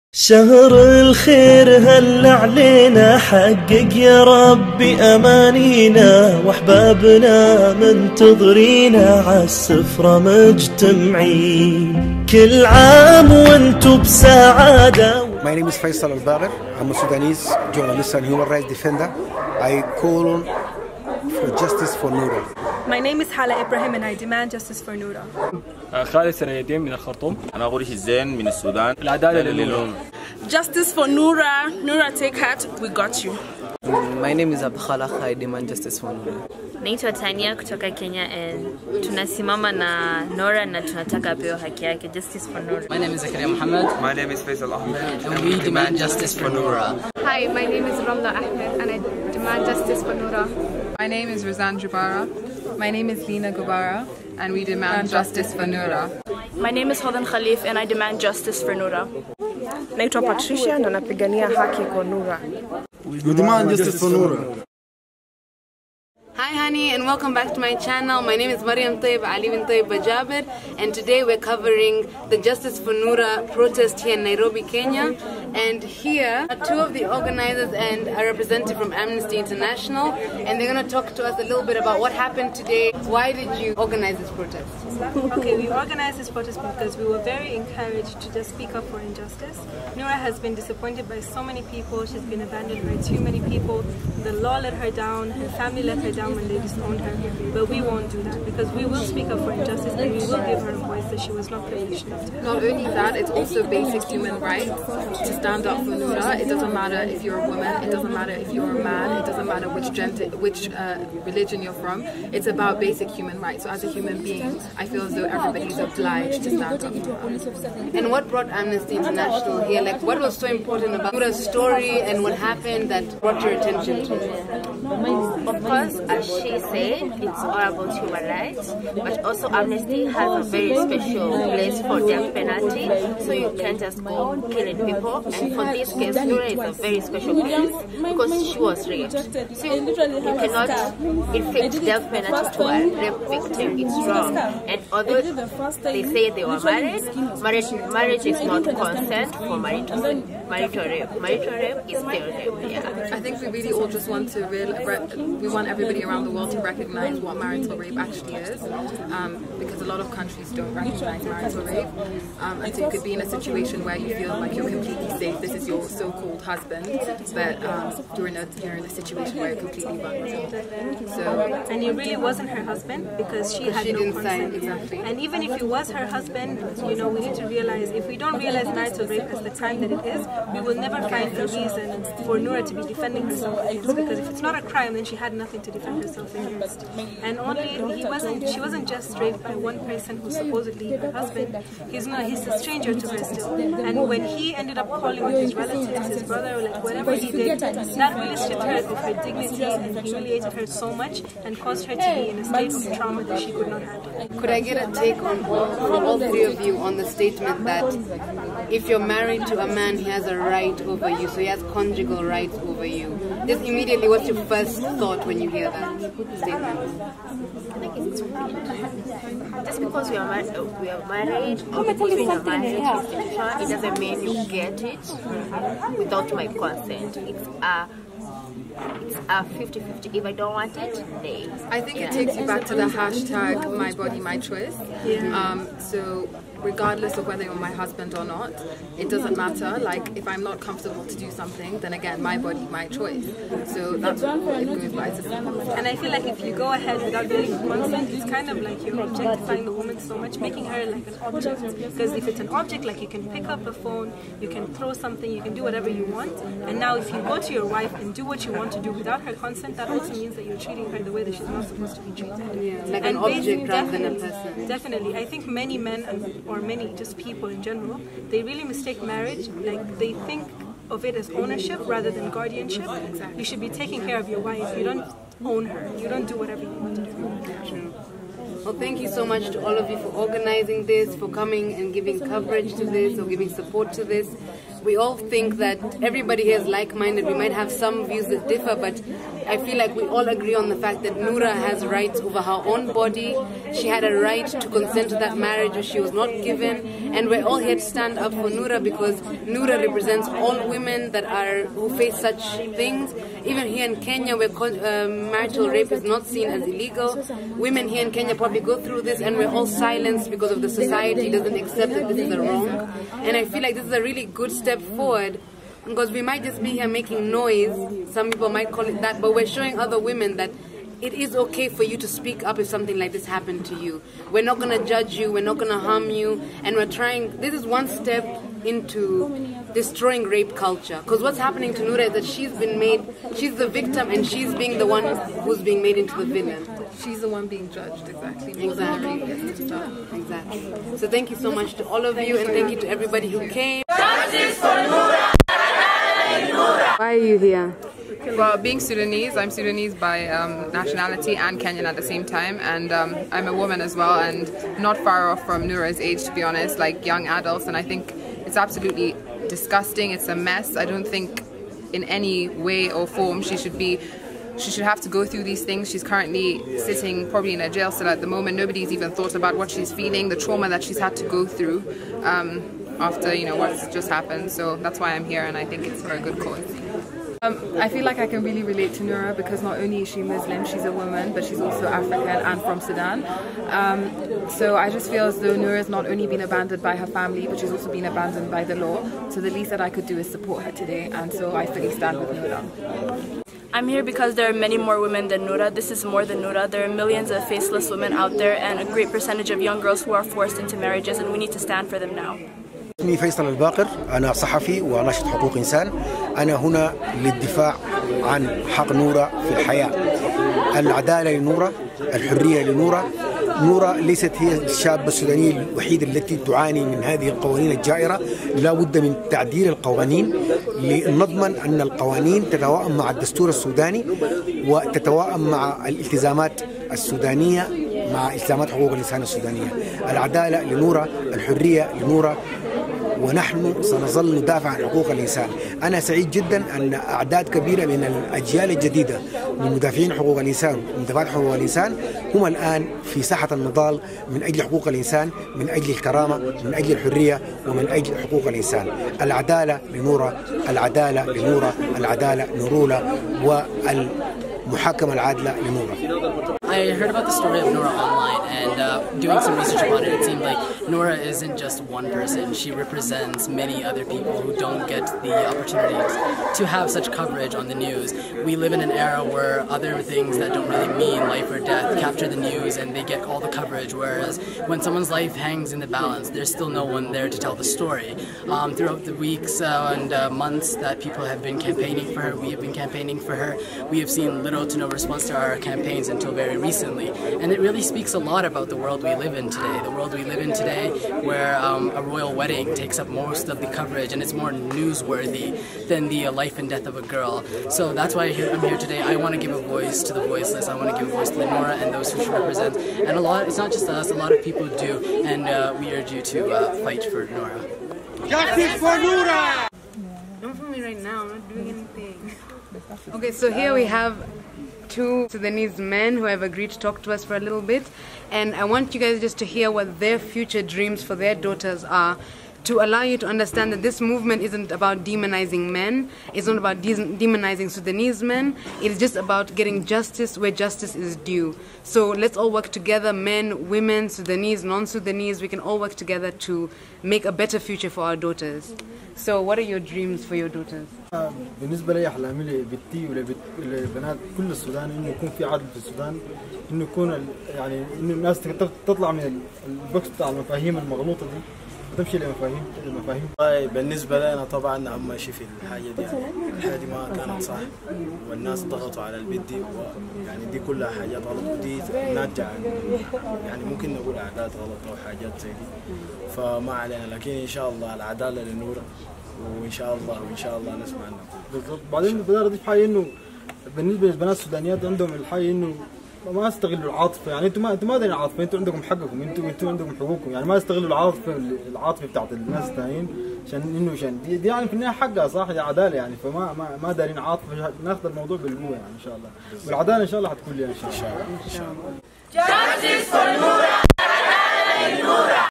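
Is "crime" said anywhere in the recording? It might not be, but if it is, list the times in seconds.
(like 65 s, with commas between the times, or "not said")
179 s, 184 s.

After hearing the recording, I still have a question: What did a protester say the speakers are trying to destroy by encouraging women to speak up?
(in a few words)
Rape culture.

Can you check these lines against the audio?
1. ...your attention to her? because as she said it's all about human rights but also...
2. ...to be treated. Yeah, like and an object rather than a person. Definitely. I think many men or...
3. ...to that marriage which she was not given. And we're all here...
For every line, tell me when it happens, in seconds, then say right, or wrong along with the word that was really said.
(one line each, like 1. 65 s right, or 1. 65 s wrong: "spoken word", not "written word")
1. 123 s right
2. 261 s right
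3. 295 s right.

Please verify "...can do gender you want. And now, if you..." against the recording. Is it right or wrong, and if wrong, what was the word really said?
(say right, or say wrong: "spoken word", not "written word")
wrong: "whatever", not "gender".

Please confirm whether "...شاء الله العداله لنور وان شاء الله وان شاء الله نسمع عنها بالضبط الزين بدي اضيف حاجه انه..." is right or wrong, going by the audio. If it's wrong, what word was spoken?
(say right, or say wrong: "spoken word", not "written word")
wrong: "بعدين", not "الزين".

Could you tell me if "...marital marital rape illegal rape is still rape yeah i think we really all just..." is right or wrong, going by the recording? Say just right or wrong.
wrong.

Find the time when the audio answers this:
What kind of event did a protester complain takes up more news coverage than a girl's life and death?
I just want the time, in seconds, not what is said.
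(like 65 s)
492 s.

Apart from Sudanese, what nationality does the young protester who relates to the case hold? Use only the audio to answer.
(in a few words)
Kenyan.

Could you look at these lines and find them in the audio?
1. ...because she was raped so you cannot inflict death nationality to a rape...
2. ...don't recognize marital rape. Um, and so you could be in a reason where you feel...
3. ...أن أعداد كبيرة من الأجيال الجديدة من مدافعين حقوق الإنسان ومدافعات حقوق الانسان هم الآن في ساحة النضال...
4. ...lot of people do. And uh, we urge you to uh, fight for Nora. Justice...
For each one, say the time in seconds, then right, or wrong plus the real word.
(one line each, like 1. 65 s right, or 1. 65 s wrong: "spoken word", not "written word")
1. 138 s wrong: "penalty", not "nationality"
2. 160 s wrong: "situation", not "reason"
3. 436 s wrong: "الإنسان", not "الانسان"
4. 504 s right.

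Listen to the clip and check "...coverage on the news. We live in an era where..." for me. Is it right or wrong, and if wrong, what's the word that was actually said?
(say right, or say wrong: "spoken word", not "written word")
right.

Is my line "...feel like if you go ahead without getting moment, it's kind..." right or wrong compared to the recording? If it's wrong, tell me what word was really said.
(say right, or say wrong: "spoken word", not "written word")
wrong: "consent", not "moment".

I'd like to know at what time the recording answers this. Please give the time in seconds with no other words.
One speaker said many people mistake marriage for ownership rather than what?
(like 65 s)
272 s.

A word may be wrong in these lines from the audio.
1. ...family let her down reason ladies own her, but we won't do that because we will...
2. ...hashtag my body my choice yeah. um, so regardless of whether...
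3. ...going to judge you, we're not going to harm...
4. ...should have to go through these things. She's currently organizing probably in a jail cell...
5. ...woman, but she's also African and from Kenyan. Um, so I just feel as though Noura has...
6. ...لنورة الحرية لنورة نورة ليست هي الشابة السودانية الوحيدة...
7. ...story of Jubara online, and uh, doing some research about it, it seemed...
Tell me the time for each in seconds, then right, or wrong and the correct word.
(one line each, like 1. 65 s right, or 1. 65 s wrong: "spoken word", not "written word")
1. 95 s wrong: "common", not "reason"
2. 232 s right
3. 324 s right
4. 364 s wrong: "sitting", not "organizing"
5. 380 s wrong: "Sudan", not "Kenyan"
6. 411 s right
7. 457 s wrong: "Nora", not "Jubara".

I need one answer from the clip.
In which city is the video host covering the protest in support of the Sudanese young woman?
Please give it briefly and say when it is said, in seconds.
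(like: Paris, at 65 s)
Nairobi, at 74 s.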